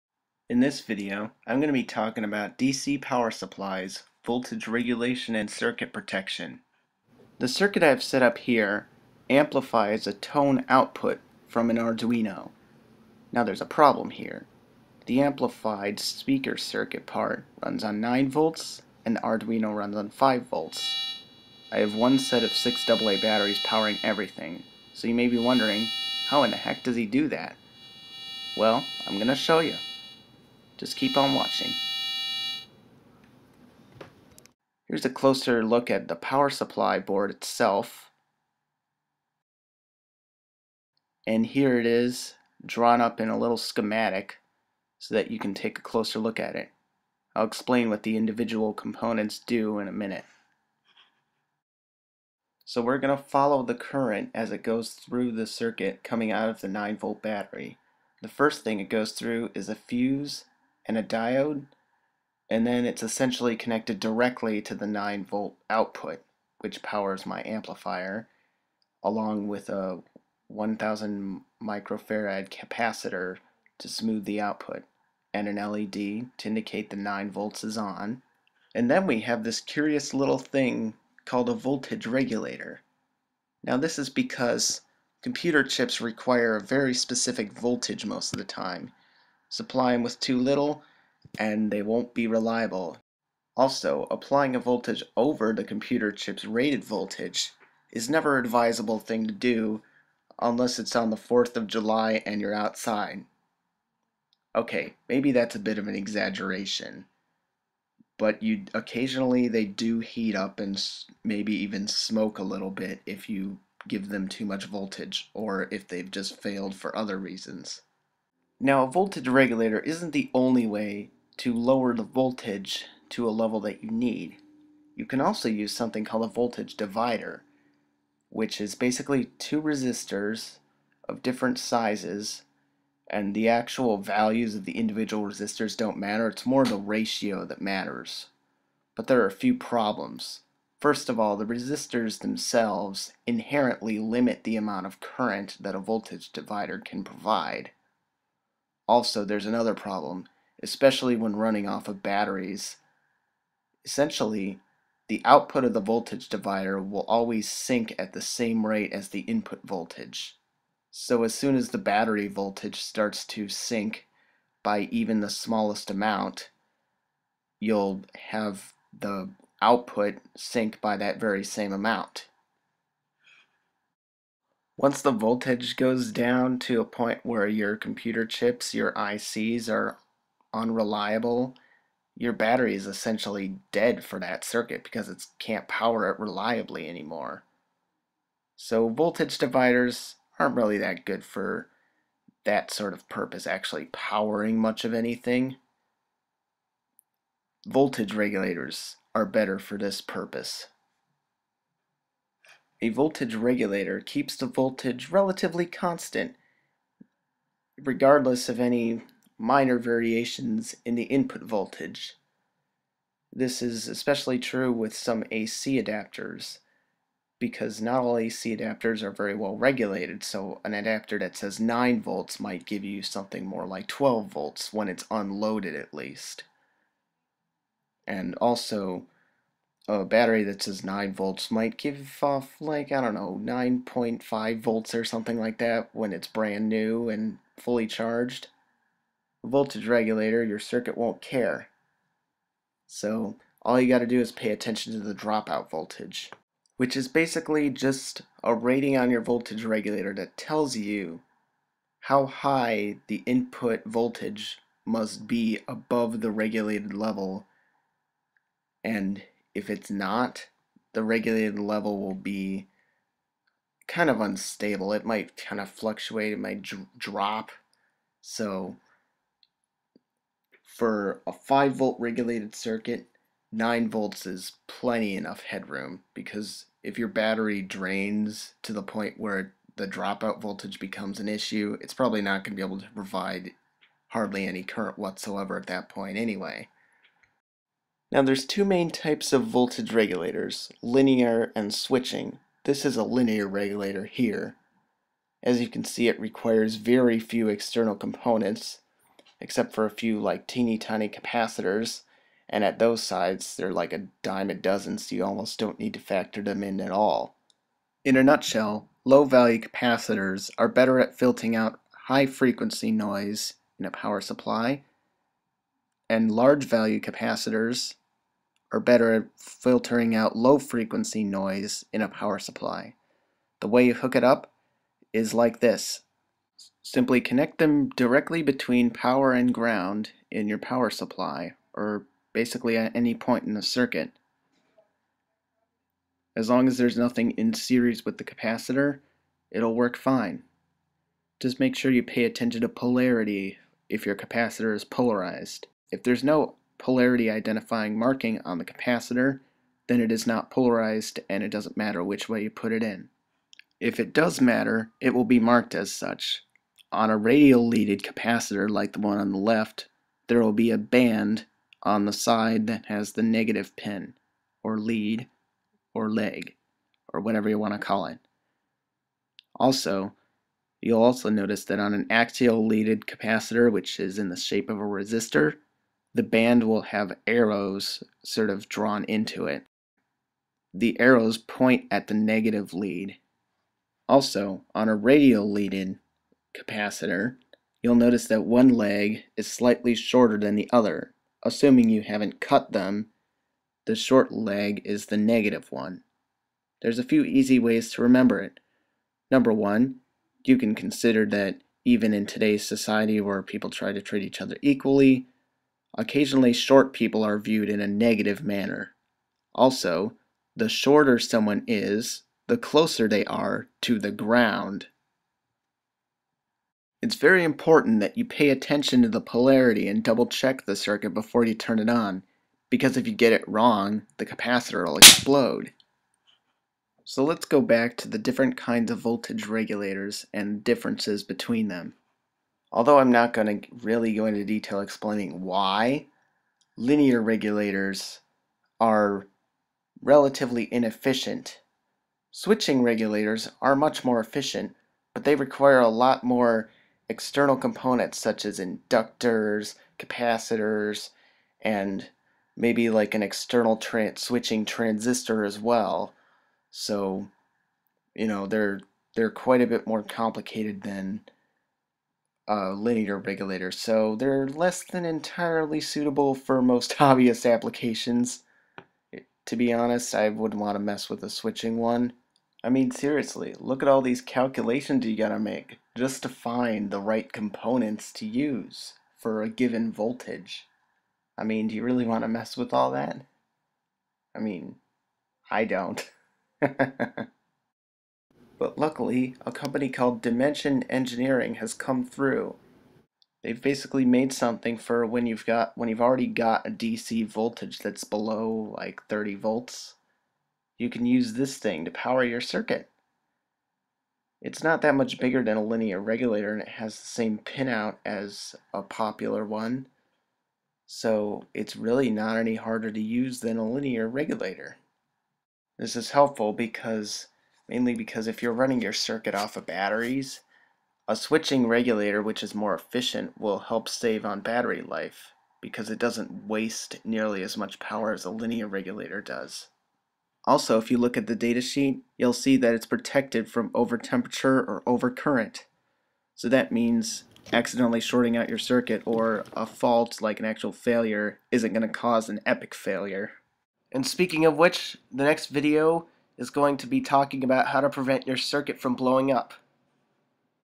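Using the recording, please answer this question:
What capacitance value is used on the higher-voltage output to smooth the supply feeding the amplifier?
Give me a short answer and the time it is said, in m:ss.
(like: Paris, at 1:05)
1000 microfarad, at 1:10.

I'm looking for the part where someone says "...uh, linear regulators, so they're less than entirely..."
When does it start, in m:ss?
7:42.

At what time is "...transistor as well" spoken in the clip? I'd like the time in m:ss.
7:34.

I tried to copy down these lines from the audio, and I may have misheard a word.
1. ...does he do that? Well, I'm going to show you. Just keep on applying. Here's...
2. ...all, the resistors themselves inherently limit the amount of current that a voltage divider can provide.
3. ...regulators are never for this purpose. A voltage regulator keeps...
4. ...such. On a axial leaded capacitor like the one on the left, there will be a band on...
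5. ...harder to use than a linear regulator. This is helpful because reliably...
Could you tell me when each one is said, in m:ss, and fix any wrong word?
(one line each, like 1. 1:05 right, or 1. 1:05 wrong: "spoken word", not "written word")
1. 0:26 wrong: "watching", not "applying"
2. 2:21 right
3. 3:18 wrong: "better", not "never"
4. 5:55 wrong: "radial", not "axial"
5. 8:32 wrong: "mainly", not "reliably".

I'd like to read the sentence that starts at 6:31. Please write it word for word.
Assuming you haven't cut them, the short leg is the negative one.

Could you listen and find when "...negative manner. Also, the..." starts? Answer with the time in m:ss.
6:47.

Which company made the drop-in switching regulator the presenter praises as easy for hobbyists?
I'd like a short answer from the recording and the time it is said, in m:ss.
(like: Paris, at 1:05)
Dimension Engineering, at 8:10.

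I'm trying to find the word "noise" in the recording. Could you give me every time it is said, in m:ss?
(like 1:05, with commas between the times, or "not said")
5:12, 5:21.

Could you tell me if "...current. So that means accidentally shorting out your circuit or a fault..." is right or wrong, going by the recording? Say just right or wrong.
right.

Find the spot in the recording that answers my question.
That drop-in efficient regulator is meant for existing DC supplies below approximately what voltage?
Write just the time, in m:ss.
8:19.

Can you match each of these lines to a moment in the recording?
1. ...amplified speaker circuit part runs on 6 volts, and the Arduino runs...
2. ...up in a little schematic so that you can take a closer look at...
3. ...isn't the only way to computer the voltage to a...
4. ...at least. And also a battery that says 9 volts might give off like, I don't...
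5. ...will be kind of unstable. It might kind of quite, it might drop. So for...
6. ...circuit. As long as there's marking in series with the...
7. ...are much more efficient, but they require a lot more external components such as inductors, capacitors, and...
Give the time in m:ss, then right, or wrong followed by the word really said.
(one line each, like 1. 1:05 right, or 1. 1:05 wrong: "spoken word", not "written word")
1. 0:15 wrong: "9", not "6"
2. 0:42 right
3. 1:59 wrong: "lower", not "computer"
4. 3:45 right
5. 4:21 wrong: "fluctuate", not "quite"
6. 5:33 wrong: "nothing", not "marking"
7. 7:23 right.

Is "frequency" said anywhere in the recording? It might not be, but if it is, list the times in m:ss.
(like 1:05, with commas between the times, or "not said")
5:12, 5:20.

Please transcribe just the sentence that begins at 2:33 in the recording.
Essentially, the output of the voltage divider will always sink at the same rate as the input voltage.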